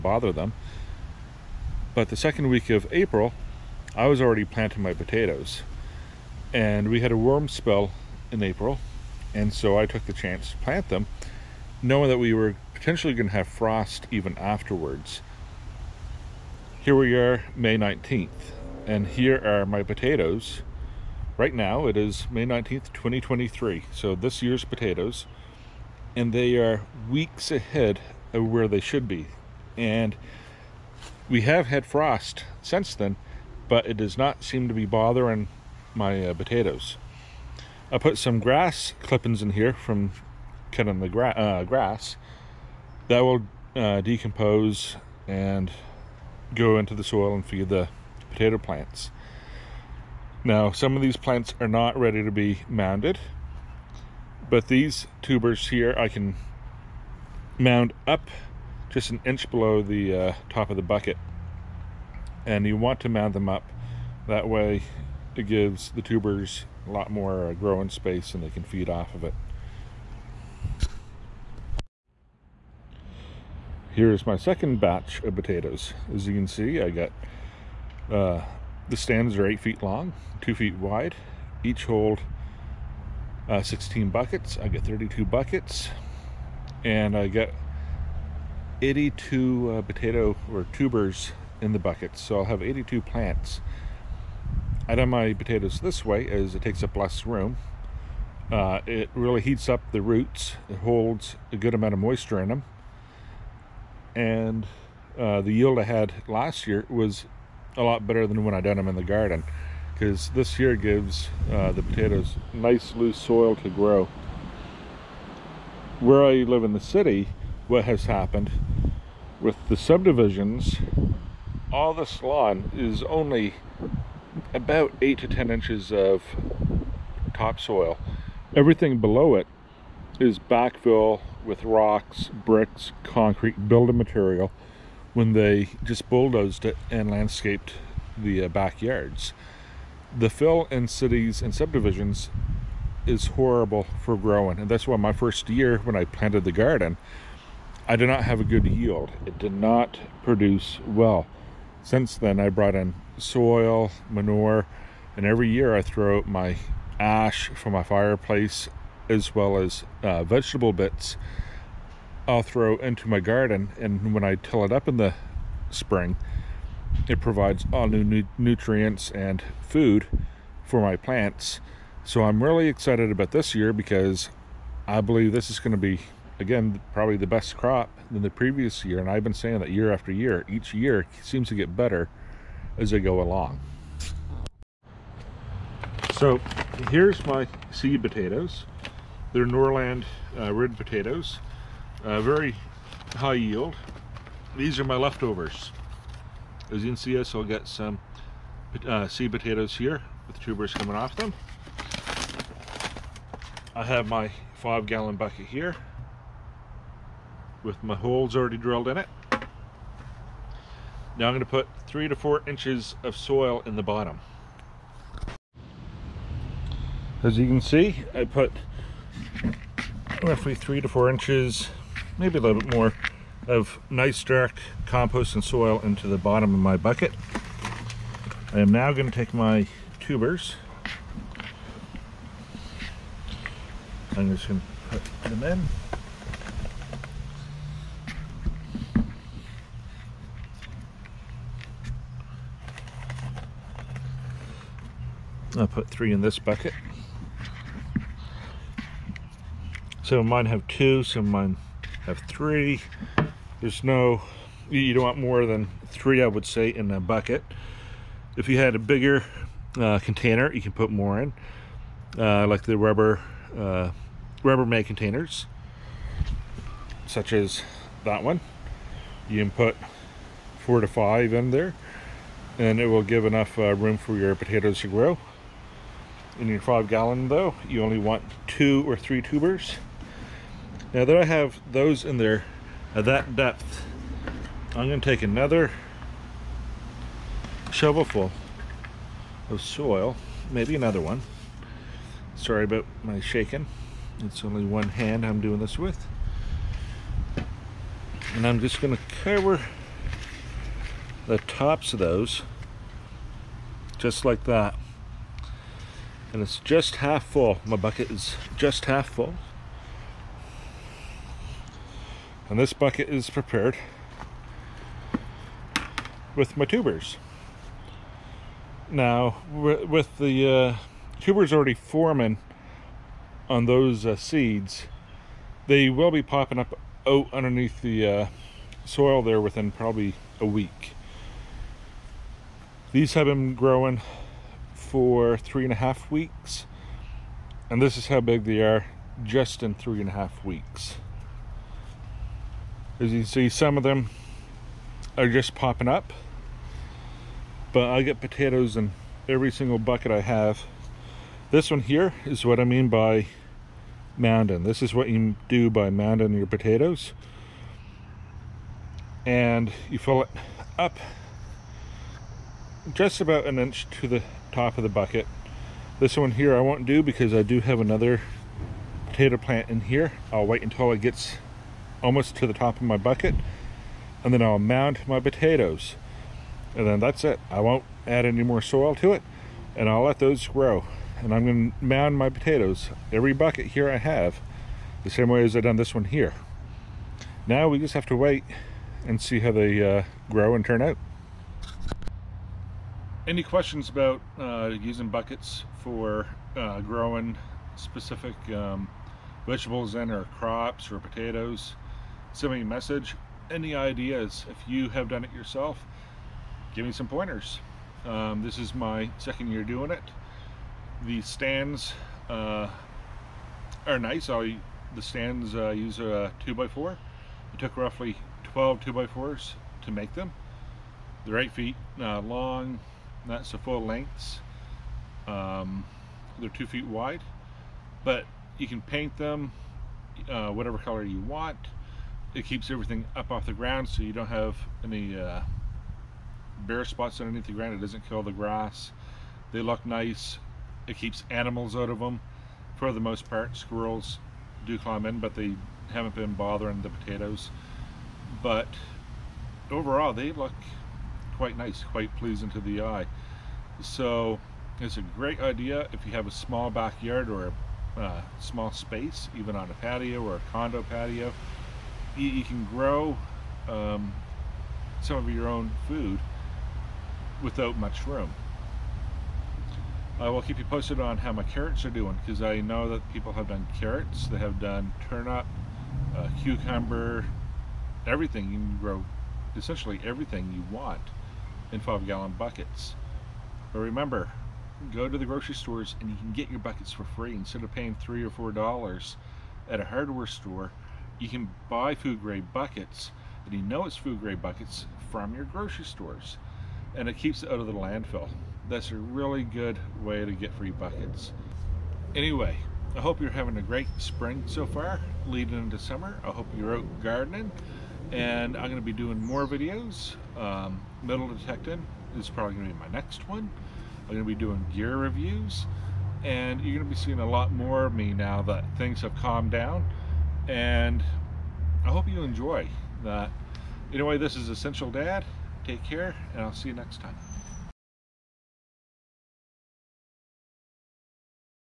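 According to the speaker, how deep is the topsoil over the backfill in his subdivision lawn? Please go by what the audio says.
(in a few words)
8 to 10 inches.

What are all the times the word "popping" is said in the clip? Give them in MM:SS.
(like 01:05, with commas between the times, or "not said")
05:26, 05:45.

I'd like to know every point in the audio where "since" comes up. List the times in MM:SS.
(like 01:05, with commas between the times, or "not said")
00:32, 02:31.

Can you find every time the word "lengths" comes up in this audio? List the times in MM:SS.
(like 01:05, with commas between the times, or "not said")
07:03.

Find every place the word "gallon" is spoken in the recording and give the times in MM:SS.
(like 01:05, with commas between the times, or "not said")
03:24, 04:36, 08:02.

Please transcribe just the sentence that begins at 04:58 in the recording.
And I'm just gonna cover the tops of those just like that.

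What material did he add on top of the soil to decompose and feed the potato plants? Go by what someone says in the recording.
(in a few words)
grass clippings.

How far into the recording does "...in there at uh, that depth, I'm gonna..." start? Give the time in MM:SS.
04:42.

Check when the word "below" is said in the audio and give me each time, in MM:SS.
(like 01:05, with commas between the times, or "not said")
00:59, 02:08.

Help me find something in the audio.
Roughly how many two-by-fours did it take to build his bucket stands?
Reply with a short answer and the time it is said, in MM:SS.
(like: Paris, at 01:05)
12, at 06:58.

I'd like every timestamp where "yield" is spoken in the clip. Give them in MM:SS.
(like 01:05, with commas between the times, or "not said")
01:45, 02:28, 03:13.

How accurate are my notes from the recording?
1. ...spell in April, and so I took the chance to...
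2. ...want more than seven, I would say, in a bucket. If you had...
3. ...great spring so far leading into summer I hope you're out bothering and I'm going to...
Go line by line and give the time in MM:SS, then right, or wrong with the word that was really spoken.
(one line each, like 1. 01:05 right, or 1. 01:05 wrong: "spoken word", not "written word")
1. 00:07 right
2. 04:15 wrong: "three", not "seven"
3. 08:23 wrong: "gardening", not "bothering".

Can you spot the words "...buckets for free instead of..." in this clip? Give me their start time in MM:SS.
08:06.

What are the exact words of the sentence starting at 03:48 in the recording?
I am now going to take my tubers.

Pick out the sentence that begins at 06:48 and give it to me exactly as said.
Um, this is my second year doing it.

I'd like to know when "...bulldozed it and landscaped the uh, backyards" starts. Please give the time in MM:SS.
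02:16.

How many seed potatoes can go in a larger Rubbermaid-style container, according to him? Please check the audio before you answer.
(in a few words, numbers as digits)
4 to 5.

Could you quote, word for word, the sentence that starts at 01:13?
Here's my second batch of potatoes.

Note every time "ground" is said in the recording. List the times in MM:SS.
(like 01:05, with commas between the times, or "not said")
07:13, 07:17.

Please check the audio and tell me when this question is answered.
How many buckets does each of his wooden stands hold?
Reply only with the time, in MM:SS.
01:23.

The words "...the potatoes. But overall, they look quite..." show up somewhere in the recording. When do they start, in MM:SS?
07:26.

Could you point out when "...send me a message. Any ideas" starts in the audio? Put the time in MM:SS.
06:42.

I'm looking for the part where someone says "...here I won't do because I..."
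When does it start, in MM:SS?
06:06.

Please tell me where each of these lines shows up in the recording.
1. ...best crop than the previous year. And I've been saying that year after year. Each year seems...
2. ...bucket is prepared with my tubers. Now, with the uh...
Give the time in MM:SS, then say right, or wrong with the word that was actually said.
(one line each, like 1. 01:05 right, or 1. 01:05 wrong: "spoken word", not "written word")
1. 02:57 right
2. 05:12 right.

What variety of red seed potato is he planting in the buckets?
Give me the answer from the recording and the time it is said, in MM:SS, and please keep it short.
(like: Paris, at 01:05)
Norland, at 03:09.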